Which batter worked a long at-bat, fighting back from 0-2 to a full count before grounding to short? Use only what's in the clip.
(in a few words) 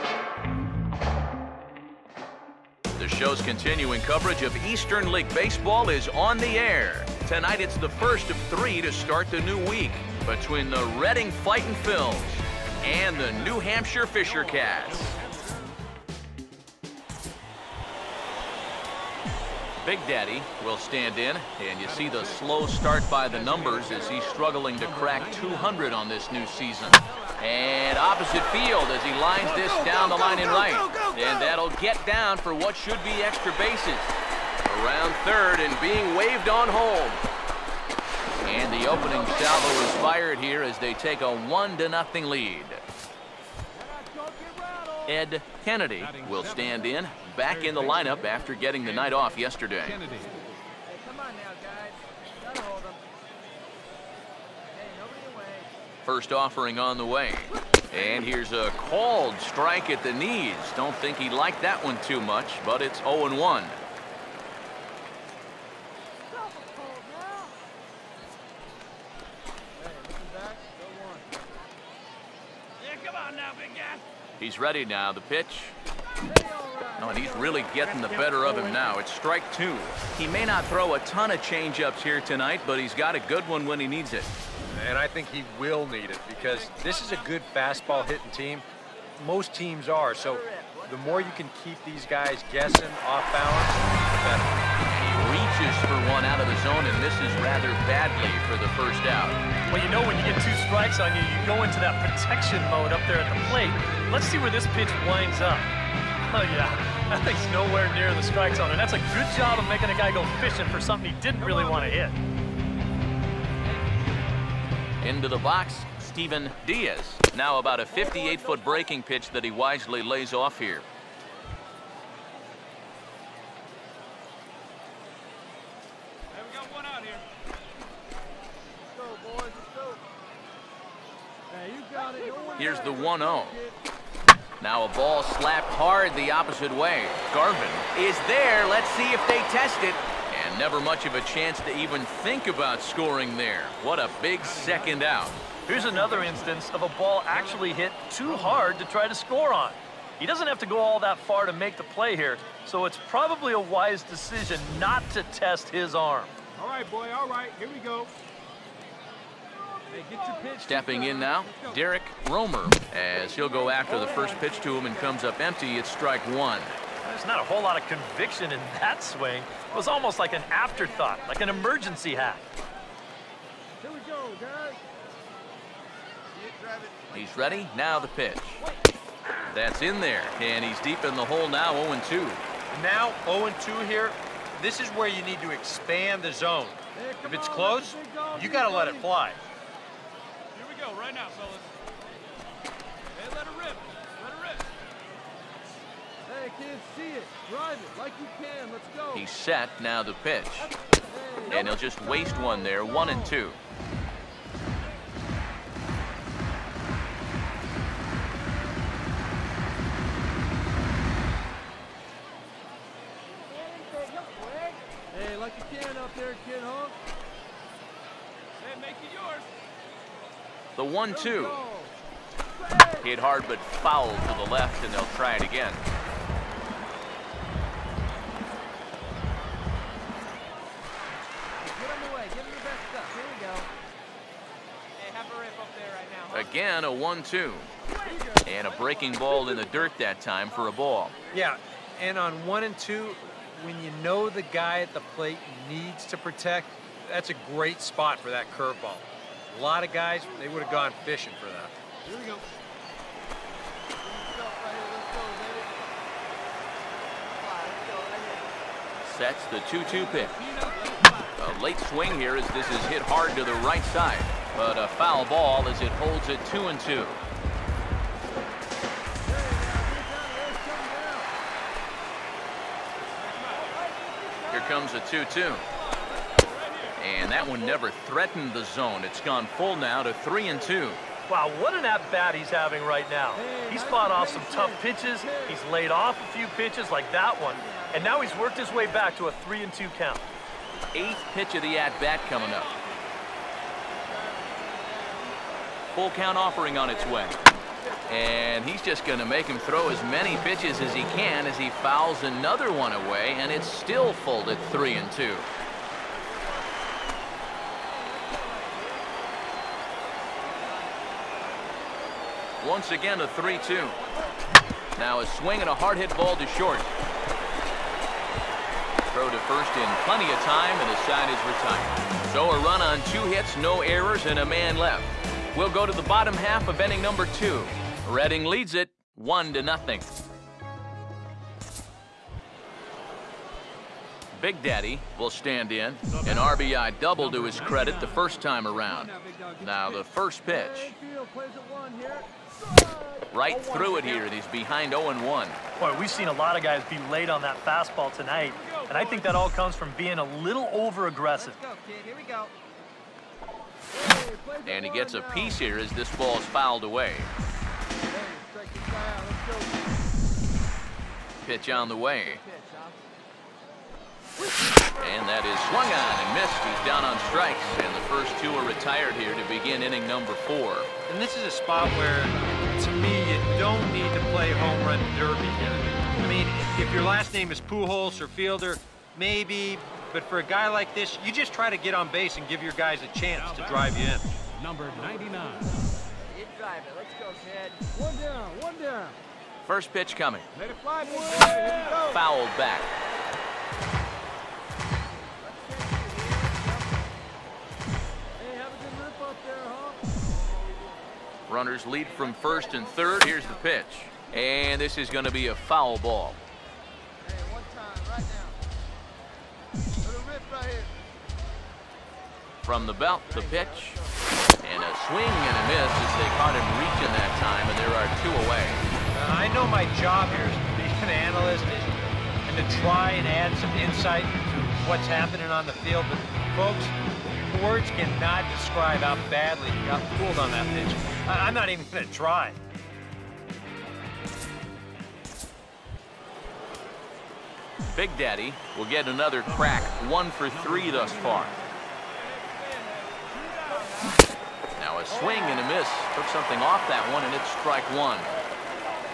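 Derek Romer.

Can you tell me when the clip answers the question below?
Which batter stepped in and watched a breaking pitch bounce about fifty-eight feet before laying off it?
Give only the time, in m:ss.
1:55.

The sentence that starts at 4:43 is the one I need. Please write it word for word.
He's fought off some tough pitches.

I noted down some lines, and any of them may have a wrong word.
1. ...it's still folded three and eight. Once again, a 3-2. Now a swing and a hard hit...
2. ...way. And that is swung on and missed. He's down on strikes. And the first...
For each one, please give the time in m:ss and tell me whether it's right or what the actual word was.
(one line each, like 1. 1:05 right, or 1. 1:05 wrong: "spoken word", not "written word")
1. 5:03 wrong: "two", not "eight"
2. 6:01 right.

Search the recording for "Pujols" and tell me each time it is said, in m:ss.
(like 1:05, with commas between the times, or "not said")
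6:17.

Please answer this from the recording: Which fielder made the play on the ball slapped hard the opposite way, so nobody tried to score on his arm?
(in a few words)
Garvin.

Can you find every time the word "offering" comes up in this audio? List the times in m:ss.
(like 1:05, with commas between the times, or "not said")
0:56, 4:56.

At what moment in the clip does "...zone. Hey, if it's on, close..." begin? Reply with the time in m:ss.
3:06.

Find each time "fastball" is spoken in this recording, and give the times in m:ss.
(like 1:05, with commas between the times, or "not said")
1:27, 5:47.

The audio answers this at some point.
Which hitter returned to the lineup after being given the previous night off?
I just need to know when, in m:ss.
0:45.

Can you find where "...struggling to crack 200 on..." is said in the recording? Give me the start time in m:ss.
0:24.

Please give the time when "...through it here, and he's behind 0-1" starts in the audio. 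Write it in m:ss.
5:43.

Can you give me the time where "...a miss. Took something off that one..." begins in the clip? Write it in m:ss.
7:25.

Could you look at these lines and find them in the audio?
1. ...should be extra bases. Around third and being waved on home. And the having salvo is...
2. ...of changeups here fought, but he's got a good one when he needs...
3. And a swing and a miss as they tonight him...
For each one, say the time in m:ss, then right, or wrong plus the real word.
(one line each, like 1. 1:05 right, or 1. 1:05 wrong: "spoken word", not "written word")
1. 0:32 wrong: "opening", not "having"
2. 1:21 wrong: "tonight", not "fought"
3. 6:54 wrong: "caught", not "tonight".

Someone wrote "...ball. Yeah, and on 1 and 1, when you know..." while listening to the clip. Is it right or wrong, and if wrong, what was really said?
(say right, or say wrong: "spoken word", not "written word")
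wrong: "2", not "1".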